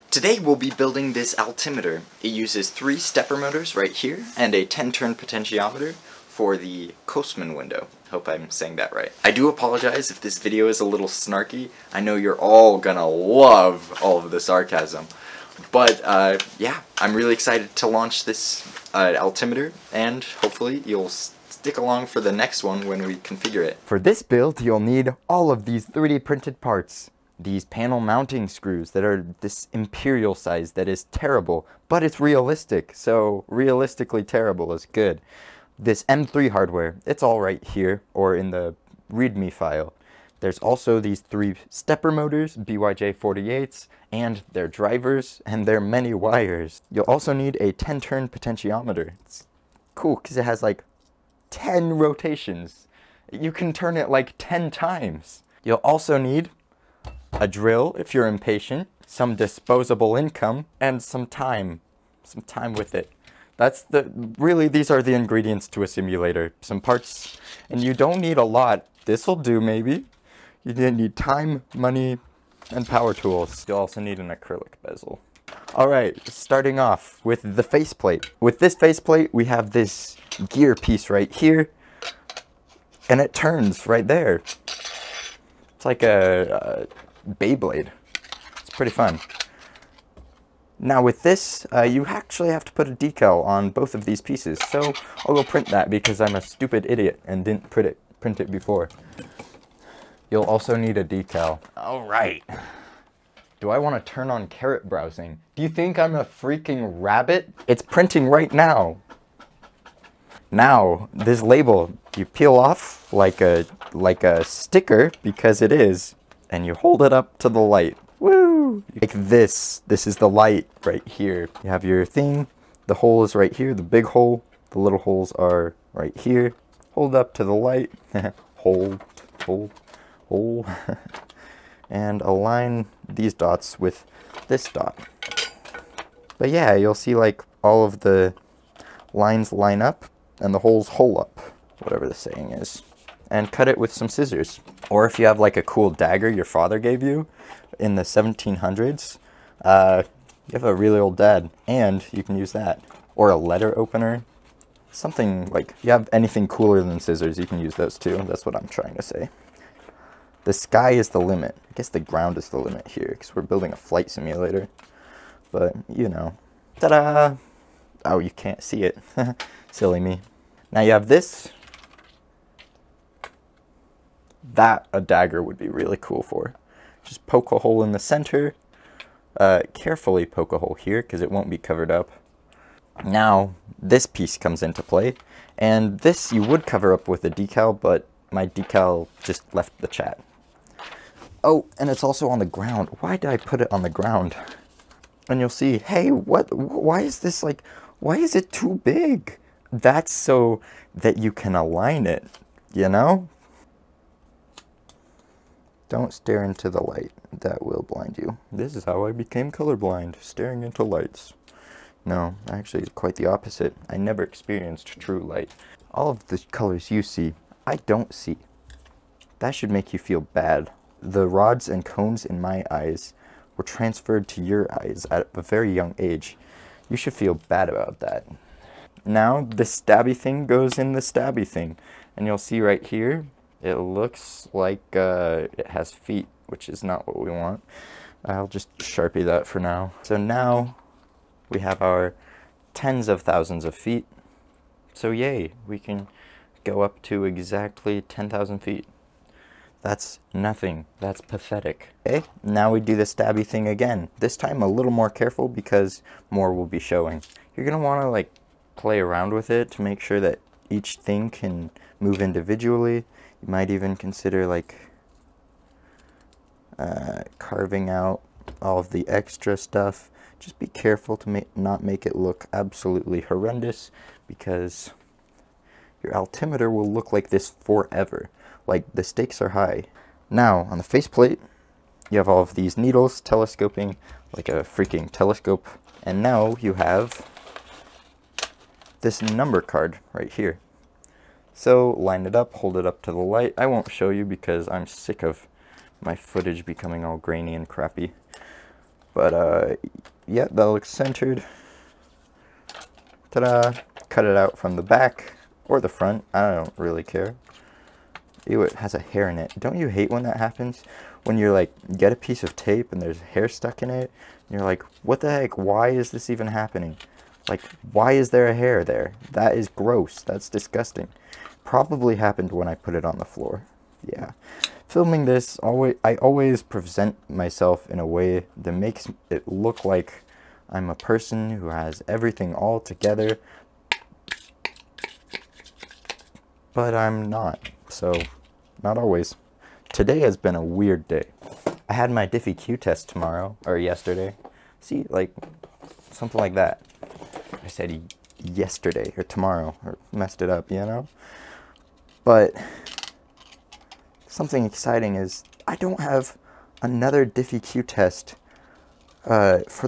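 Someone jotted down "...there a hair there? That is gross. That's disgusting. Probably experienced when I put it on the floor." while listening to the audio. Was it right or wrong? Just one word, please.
wrong.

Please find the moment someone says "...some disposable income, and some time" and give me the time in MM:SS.
00:59.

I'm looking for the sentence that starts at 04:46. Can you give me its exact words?
And now you have this number card right here.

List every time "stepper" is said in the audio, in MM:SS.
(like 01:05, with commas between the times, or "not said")
00:02, 00:41.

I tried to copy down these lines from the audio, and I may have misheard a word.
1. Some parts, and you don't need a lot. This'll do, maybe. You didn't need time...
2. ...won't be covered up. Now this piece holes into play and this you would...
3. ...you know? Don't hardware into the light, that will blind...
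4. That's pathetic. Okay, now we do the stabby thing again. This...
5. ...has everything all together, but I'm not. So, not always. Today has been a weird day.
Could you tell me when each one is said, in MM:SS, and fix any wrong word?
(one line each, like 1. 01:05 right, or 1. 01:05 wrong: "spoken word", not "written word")
1. 01:06 right
2. 03:01 wrong: "comes", not "holes"
3. 03:22 wrong: "stare", not "hardware"
4. 04:10 right
5. 05:31 right.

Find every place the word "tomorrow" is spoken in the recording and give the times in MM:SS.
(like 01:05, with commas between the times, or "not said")
05:43, 05:49.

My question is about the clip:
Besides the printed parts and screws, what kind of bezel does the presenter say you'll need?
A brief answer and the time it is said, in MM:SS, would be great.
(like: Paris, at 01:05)
Acrylic, at 01:14.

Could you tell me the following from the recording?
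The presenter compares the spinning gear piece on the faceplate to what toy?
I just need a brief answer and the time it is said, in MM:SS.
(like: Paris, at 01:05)
Beyblade, at 01:27.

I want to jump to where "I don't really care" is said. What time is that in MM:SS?
05:06.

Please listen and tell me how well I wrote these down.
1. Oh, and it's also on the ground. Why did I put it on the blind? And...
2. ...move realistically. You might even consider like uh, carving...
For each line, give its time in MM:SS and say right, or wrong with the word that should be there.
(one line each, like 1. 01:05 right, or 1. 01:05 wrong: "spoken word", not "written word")
1. 03:11 wrong: "ground", not "blind"
2. 04:21 wrong: "individually", not "realistically".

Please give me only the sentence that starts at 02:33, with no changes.
Or a letter opener, something like, if you have anything cooler than scissors, you can use those too.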